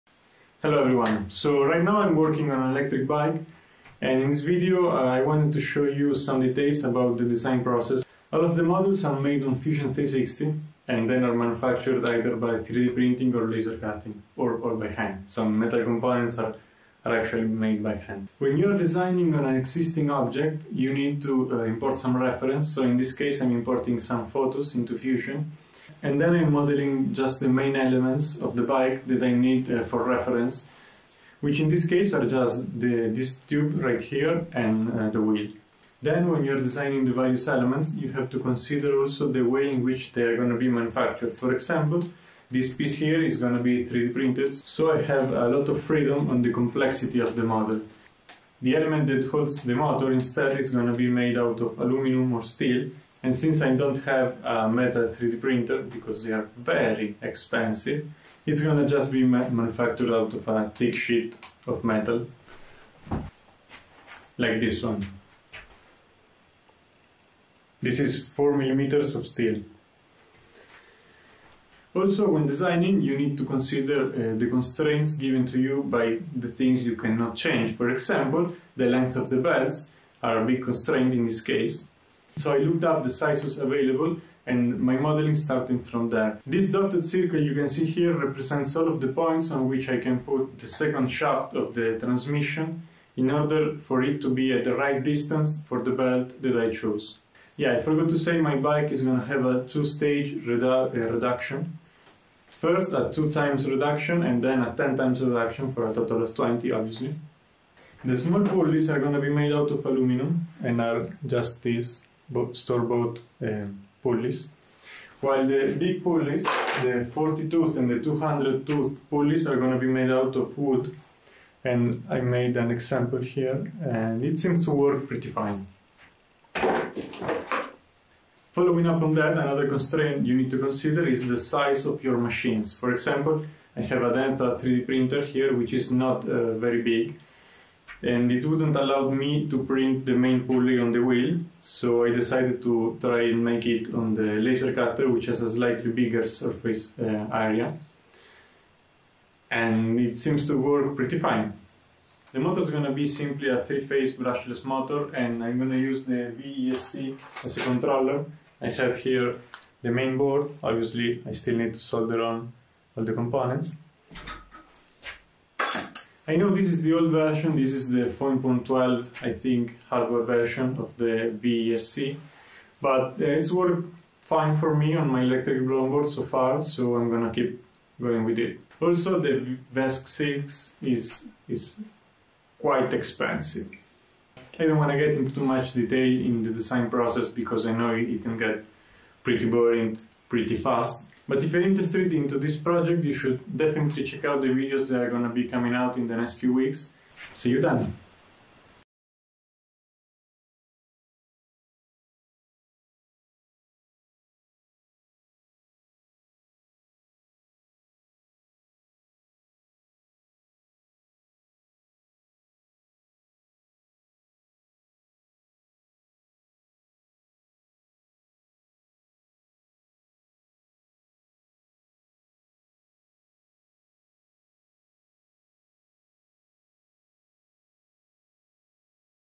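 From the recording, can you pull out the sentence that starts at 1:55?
While the big pulleys, the 40 tooth and the 200 tooth pulleys are going to be made out of wood.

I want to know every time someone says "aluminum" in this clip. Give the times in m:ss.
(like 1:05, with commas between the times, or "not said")
0:51, 1:49.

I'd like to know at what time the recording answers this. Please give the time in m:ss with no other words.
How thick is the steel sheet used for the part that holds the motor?
1:08.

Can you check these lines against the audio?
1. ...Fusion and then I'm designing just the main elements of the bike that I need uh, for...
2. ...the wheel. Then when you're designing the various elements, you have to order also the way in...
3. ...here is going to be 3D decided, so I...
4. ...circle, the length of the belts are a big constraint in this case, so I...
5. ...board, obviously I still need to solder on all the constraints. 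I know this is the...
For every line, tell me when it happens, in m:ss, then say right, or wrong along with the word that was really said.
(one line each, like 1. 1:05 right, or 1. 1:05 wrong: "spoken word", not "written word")
1. 0:24 wrong: "modeling", not "designing"
2. 0:35 wrong: "consider", not "order"
3. 0:42 wrong: "printed", not "decided"
4. 1:17 wrong: "example", not "circle"
5. 2:40 wrong: "components", not "constraints".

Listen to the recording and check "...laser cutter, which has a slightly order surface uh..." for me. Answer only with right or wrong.
wrong.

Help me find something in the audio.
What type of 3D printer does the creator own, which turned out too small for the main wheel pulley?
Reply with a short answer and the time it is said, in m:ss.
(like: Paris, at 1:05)
Delta, at 2:14.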